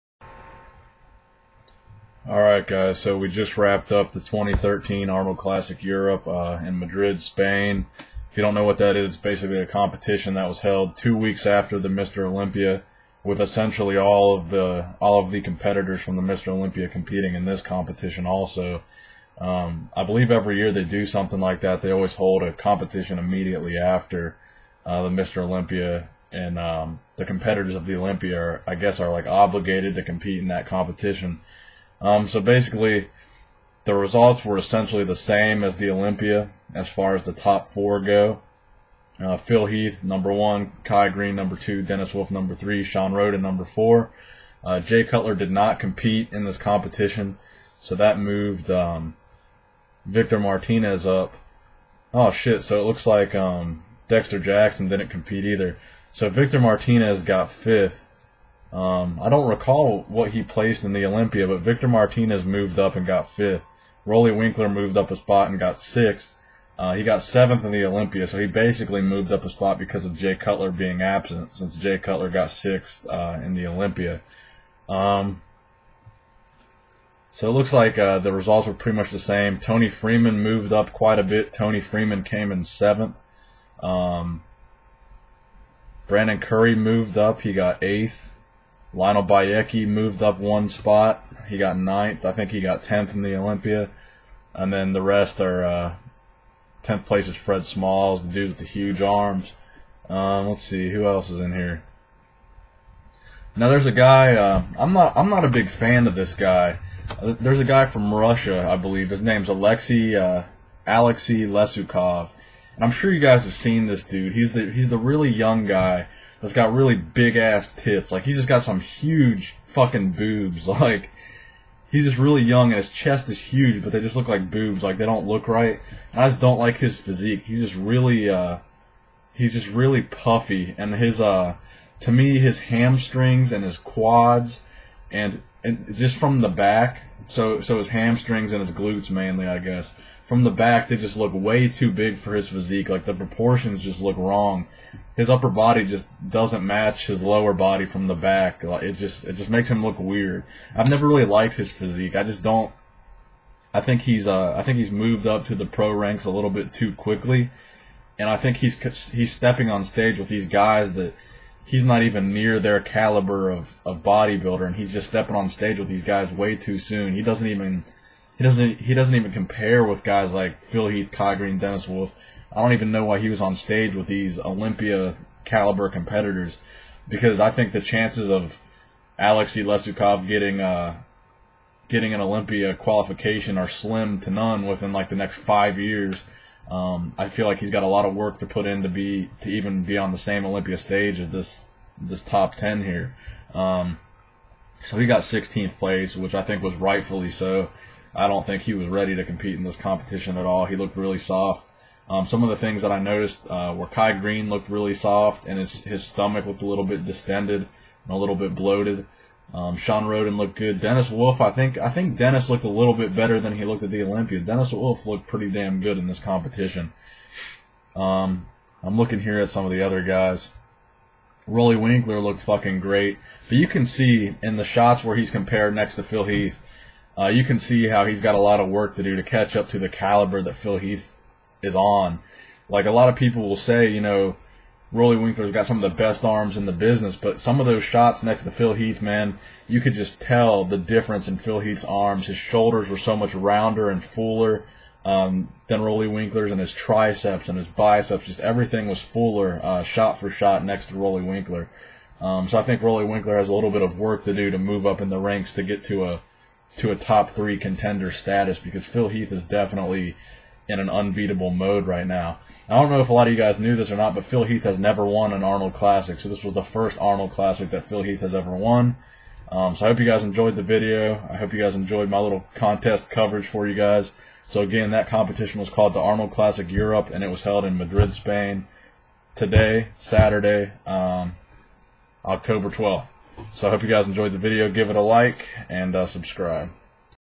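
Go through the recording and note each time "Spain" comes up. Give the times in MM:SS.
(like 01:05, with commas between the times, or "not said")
00:07, 04:38.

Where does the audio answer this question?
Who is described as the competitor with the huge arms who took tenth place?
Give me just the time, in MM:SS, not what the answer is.
01:37.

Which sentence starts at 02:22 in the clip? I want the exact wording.
Like the proportions just look wrong.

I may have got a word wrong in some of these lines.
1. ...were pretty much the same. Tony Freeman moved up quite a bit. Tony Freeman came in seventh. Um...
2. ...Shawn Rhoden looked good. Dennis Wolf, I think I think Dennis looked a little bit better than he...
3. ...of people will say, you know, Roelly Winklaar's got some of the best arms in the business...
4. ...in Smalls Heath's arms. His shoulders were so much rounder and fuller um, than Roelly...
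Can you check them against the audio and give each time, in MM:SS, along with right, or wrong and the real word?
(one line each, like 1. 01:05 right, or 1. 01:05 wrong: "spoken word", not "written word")
1. 01:18 right
2. 03:29 right
3. 03:53 right
4. 04:01 wrong: "Phil", not "Smalls".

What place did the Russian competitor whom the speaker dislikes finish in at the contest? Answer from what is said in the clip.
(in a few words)
16th.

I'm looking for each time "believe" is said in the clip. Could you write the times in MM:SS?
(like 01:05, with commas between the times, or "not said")
00:20, 01:48.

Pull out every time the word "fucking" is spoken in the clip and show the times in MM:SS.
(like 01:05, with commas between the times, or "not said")
01:59, 03:42.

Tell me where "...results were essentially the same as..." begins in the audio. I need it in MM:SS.
00:33.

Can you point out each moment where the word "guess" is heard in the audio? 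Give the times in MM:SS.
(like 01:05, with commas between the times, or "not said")
00:28, 02:19.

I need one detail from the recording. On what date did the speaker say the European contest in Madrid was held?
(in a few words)
October 12th.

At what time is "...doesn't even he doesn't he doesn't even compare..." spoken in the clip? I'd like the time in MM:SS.
02:47.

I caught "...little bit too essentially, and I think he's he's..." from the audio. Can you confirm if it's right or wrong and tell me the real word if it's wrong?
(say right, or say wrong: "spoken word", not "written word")
wrong: "quickly", not "essentially".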